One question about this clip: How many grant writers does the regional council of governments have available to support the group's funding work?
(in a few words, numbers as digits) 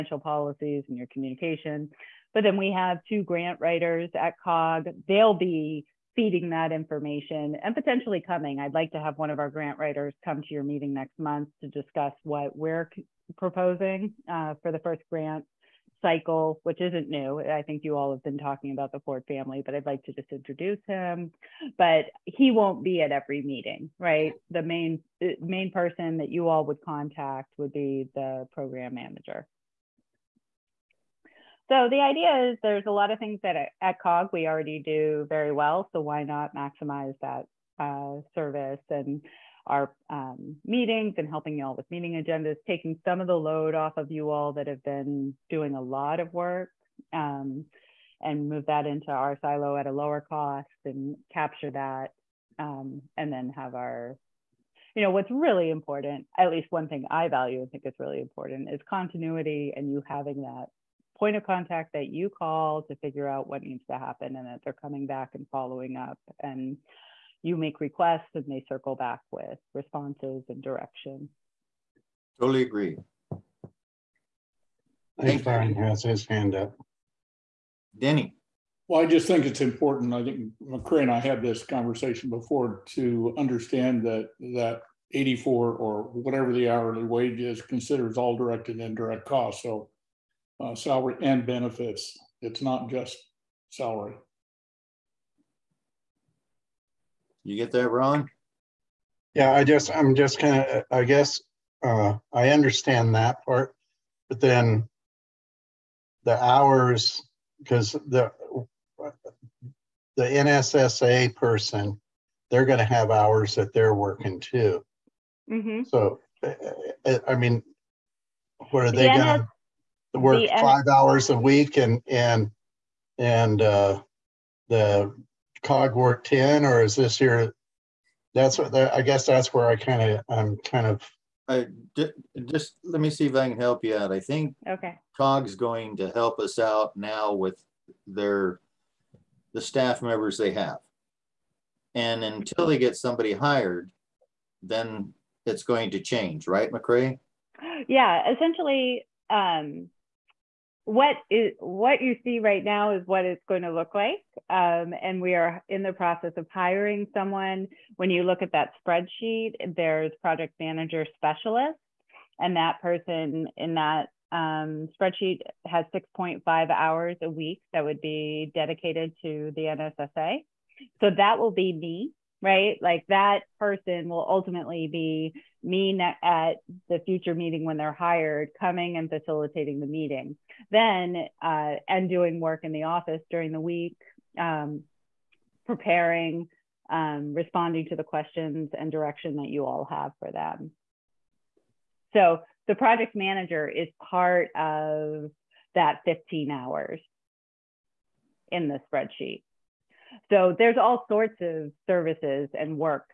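2.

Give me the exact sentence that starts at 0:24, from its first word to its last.
The main uh, main person that you all would contact would be the program manager.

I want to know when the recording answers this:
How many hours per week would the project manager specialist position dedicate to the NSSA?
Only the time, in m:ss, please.
2:45.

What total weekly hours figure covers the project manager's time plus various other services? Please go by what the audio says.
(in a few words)
15.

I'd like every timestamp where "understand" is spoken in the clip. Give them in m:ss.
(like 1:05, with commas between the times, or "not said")
1:23, 1:42.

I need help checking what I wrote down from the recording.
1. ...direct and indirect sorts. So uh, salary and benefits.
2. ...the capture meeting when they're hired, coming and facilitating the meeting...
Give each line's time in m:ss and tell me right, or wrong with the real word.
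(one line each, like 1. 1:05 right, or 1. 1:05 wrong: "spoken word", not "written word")
1. 1:28 wrong: "costs", not "sorts"
2. 2:56 wrong: "future", not "capture".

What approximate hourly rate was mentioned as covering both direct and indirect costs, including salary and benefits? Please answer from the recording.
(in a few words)
84.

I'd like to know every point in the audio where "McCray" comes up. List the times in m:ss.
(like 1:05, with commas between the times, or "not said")
1:20, 2:26.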